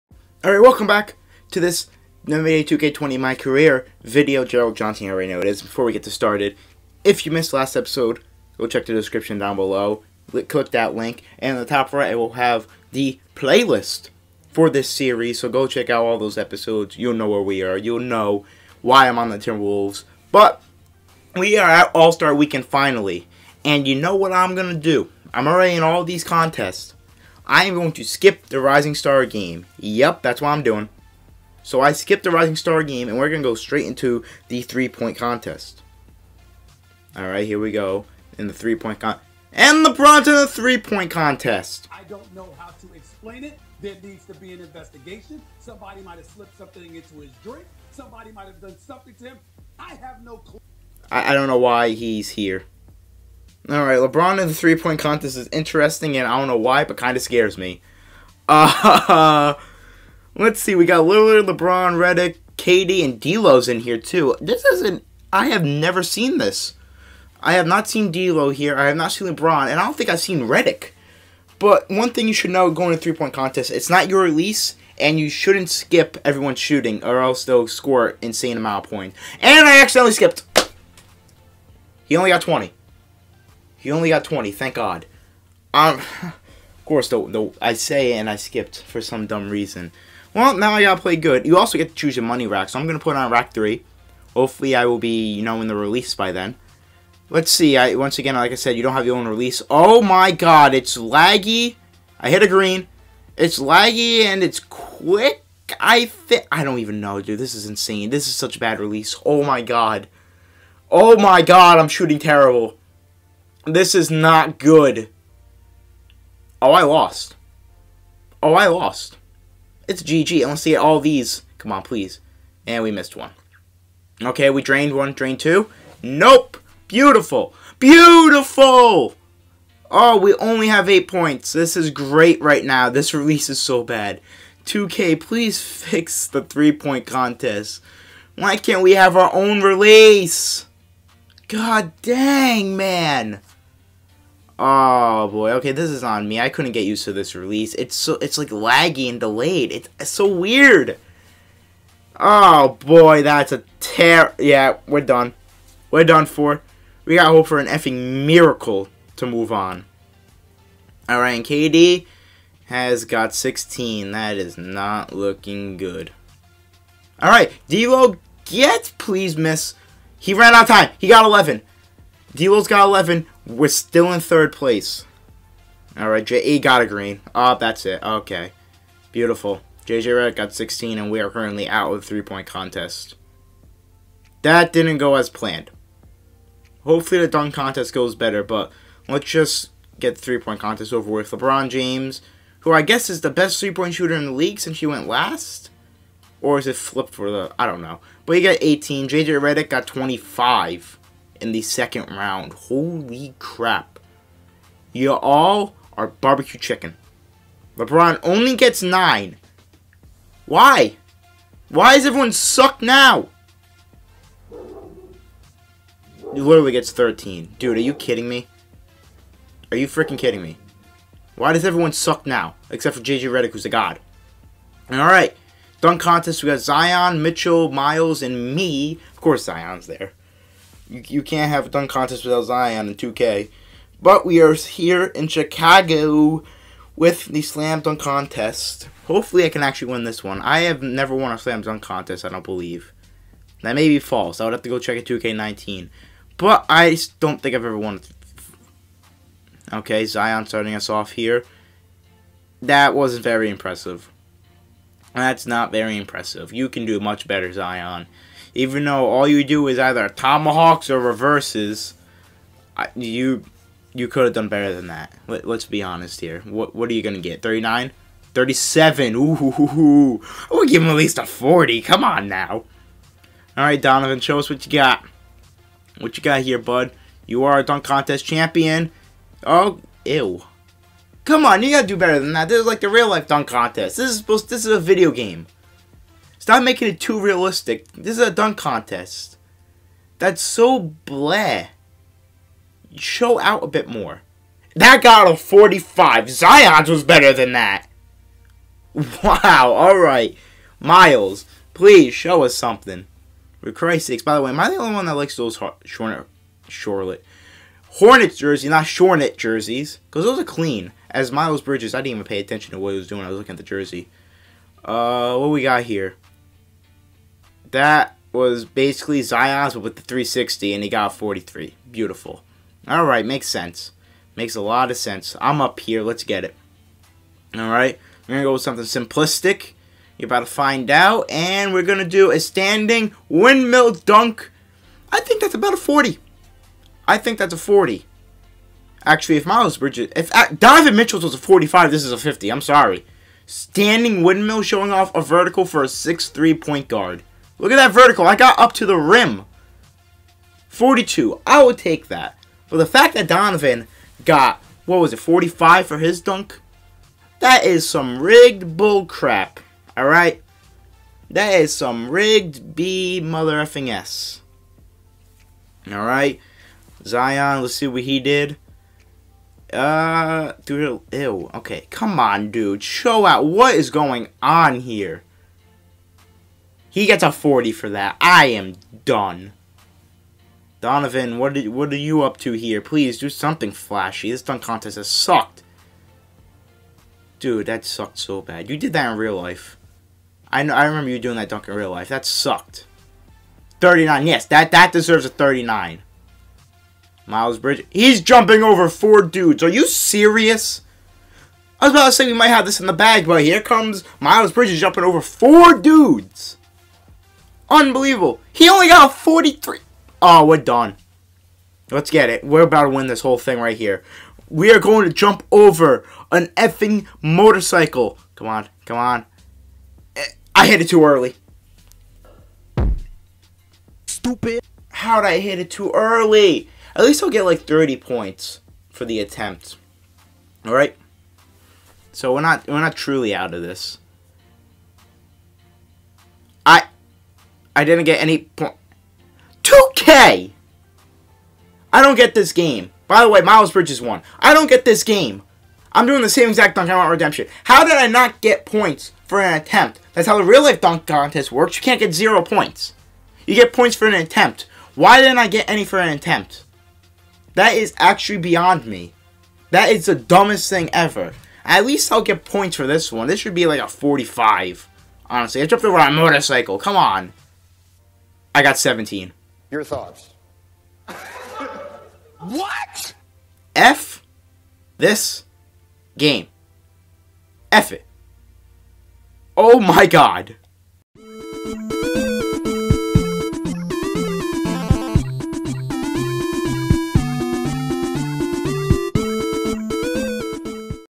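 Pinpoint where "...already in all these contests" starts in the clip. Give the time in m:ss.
0:25.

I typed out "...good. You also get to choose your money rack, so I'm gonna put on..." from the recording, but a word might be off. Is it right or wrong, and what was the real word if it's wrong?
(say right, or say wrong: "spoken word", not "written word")
right.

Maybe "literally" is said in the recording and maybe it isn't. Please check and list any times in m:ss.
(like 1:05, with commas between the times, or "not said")
3:36.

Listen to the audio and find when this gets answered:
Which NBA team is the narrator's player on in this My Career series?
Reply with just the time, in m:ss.
0:19.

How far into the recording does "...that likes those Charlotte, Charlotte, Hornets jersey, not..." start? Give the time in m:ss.
5:05.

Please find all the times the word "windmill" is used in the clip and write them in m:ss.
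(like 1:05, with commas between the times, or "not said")
5:33, 5:44.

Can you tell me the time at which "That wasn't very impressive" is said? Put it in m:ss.
4:12.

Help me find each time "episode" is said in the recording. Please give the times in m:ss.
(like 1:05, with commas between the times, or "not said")
0:07, 0:16.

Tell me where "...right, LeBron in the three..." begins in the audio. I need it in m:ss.
0:53.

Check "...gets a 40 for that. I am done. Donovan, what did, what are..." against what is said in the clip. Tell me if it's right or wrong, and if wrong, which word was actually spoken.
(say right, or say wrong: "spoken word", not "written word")
right.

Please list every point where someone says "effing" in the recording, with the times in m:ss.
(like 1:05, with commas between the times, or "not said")
2:37, 6:03, 6:56.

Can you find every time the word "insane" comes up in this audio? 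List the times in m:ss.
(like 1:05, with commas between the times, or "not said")
1:18, 1:47.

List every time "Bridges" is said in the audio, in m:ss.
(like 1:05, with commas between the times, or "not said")
5:11, 5:39, 6:37, 6:44, 7:23.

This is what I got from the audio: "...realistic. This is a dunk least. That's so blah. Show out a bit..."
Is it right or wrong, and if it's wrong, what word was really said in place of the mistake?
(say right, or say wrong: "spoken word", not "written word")
wrong: "contest", not "least".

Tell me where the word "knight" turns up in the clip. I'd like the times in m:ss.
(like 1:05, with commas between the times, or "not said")
not said.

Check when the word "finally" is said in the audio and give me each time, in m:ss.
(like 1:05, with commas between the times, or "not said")
0:22.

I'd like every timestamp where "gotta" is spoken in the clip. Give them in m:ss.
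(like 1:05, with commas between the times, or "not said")
1:30, 4:41.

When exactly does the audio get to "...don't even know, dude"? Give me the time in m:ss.
1:46.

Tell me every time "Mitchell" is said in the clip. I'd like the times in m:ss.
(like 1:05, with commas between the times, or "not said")
3:47, 5:40.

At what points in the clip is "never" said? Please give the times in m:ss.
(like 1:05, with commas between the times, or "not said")
1:05, 4:00.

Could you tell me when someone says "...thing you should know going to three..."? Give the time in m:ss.
1:12.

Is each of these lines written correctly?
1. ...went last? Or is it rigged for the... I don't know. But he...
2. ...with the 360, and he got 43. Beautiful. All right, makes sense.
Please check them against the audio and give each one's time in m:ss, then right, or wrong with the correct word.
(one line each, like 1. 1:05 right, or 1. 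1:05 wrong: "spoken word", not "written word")
1. 3:14 wrong: "flipped", not "rigged"
2. 5:19 right.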